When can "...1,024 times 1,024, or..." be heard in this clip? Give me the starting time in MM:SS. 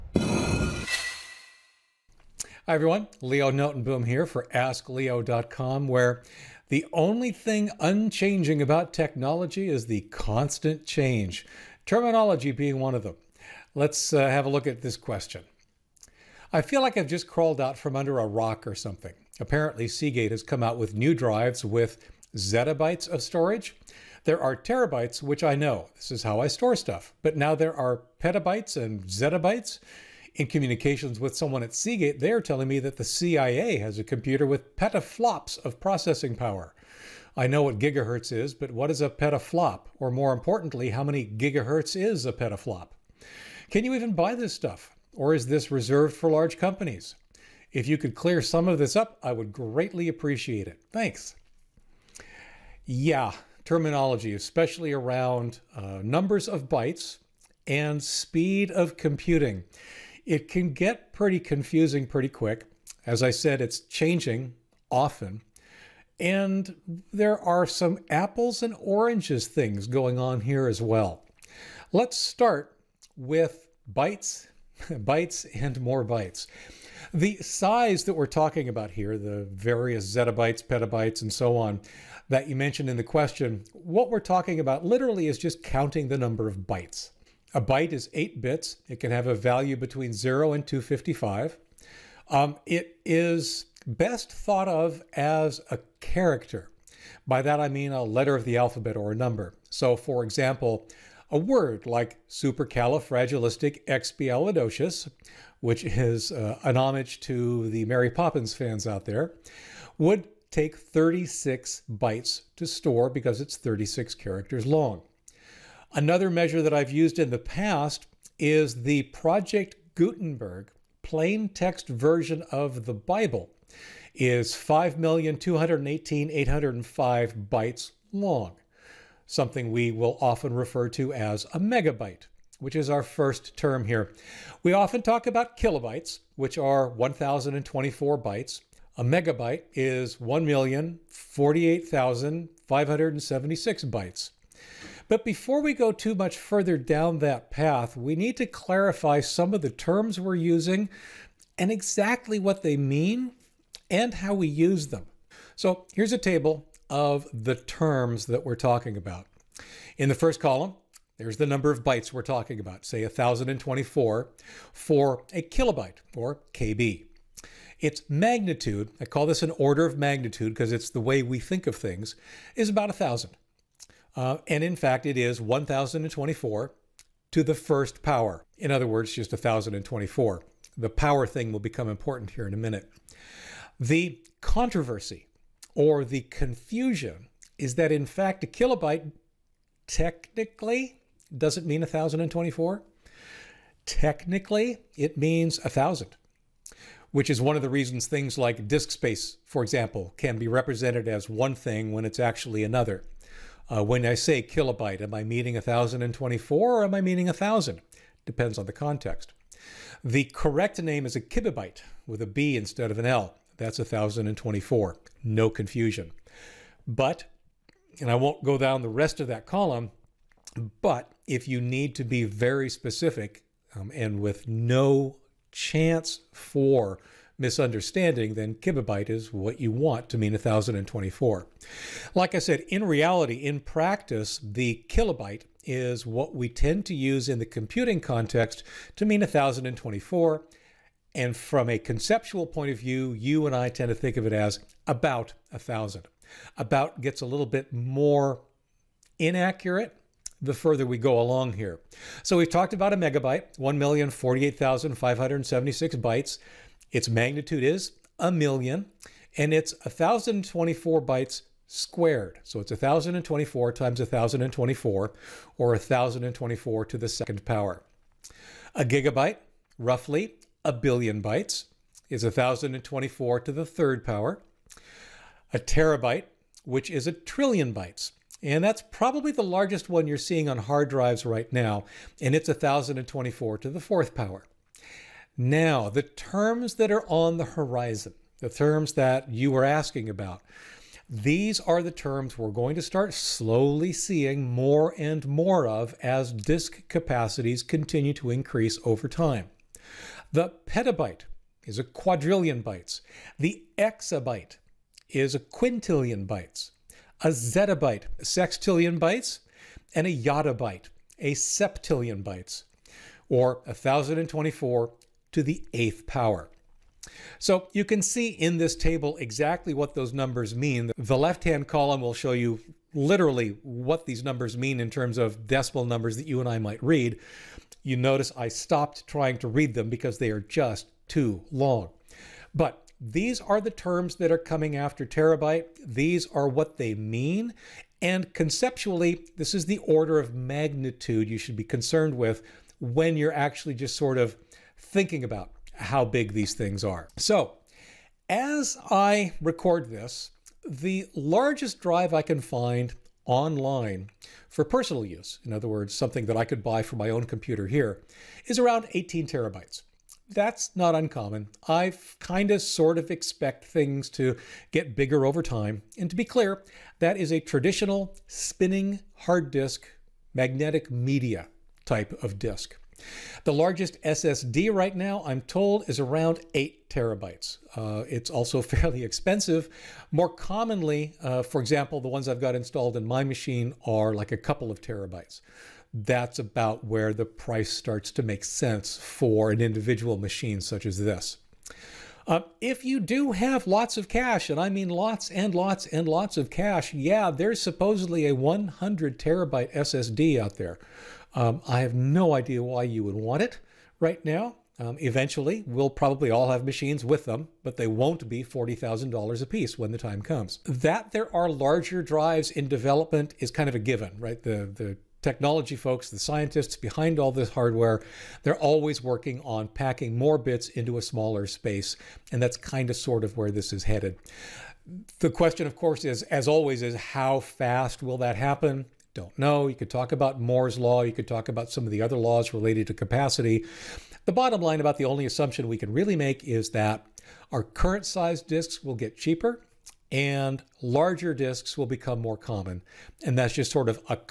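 04:22.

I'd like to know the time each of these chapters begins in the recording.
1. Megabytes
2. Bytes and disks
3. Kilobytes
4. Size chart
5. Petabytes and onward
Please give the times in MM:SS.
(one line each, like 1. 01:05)
1. 04:13
2. 05:46
3. 03:30
4. 02:39
5. 05:01.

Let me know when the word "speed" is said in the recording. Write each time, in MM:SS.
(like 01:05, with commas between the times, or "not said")
00:58.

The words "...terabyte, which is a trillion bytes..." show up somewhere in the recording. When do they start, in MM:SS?
04:35.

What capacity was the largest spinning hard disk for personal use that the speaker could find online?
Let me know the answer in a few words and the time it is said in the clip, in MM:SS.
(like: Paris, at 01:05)
18 terabytes, at 05:58.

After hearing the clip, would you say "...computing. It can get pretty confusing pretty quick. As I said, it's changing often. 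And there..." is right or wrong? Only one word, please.
right.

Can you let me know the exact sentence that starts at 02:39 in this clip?
In the first column, there's the number of bytes we're talking about, say 1024 for a kilobyte or KB.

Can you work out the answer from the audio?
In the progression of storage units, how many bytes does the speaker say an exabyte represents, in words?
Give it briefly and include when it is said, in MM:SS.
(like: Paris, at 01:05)
a quintillion, at 05:05.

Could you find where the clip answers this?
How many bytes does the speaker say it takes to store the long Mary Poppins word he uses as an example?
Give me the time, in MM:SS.
01:50.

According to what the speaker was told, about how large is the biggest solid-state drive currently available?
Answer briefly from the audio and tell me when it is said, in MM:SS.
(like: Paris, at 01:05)
8 terabytes, at 06:16.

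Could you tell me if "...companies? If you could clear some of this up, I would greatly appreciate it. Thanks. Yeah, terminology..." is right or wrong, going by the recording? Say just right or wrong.
right.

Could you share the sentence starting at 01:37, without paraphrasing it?
By that I mean a letter of the alphabet or a number.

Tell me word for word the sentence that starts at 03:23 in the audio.
Uh, when I say kilobyte, am I meaning 1024 or am I meaning 1000?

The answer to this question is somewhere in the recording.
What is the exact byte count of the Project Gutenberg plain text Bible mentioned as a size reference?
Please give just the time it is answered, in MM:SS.
02:04.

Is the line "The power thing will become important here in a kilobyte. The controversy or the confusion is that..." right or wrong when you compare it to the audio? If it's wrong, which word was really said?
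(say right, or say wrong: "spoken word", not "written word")
wrong: "minute", not "kilobyte".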